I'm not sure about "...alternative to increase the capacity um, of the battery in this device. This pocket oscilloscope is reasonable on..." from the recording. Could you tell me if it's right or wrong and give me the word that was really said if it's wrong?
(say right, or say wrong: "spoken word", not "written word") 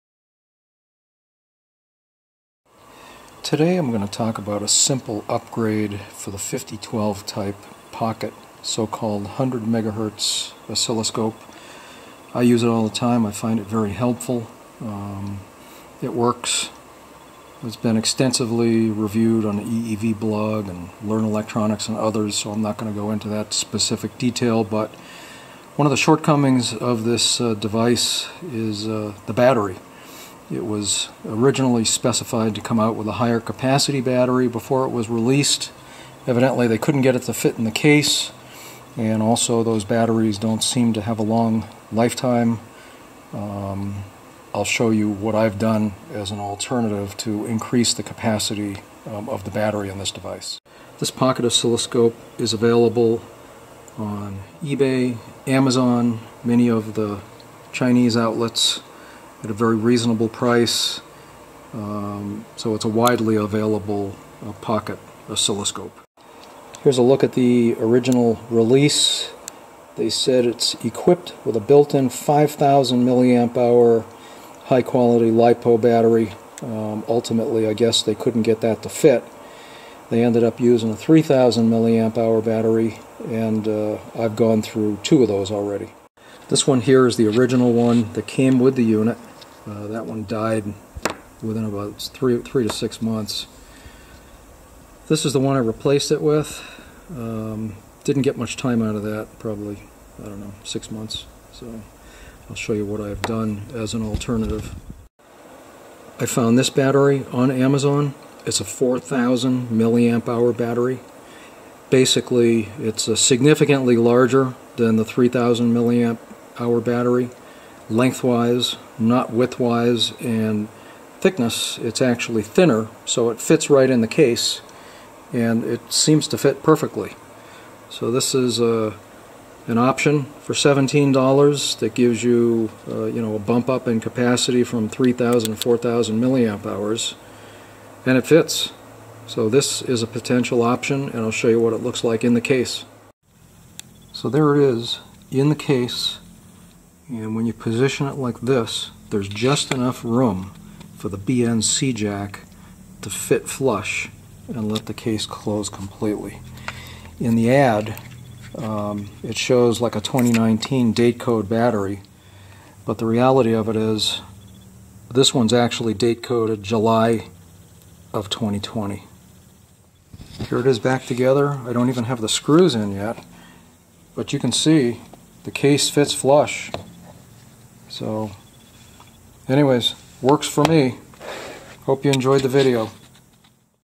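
wrong: "available", not "reasonable".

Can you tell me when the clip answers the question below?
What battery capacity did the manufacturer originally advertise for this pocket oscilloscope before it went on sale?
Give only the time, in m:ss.
1:12.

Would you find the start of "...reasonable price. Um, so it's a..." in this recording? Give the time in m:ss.
0:59.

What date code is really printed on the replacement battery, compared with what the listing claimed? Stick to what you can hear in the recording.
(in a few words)
July 2020.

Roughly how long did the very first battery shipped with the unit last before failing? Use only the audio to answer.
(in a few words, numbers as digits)
3 to 6 months.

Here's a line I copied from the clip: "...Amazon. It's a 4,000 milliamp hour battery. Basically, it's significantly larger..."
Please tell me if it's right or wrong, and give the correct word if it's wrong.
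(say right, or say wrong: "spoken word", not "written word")
right.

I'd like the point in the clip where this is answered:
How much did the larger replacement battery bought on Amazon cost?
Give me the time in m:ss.
2:10.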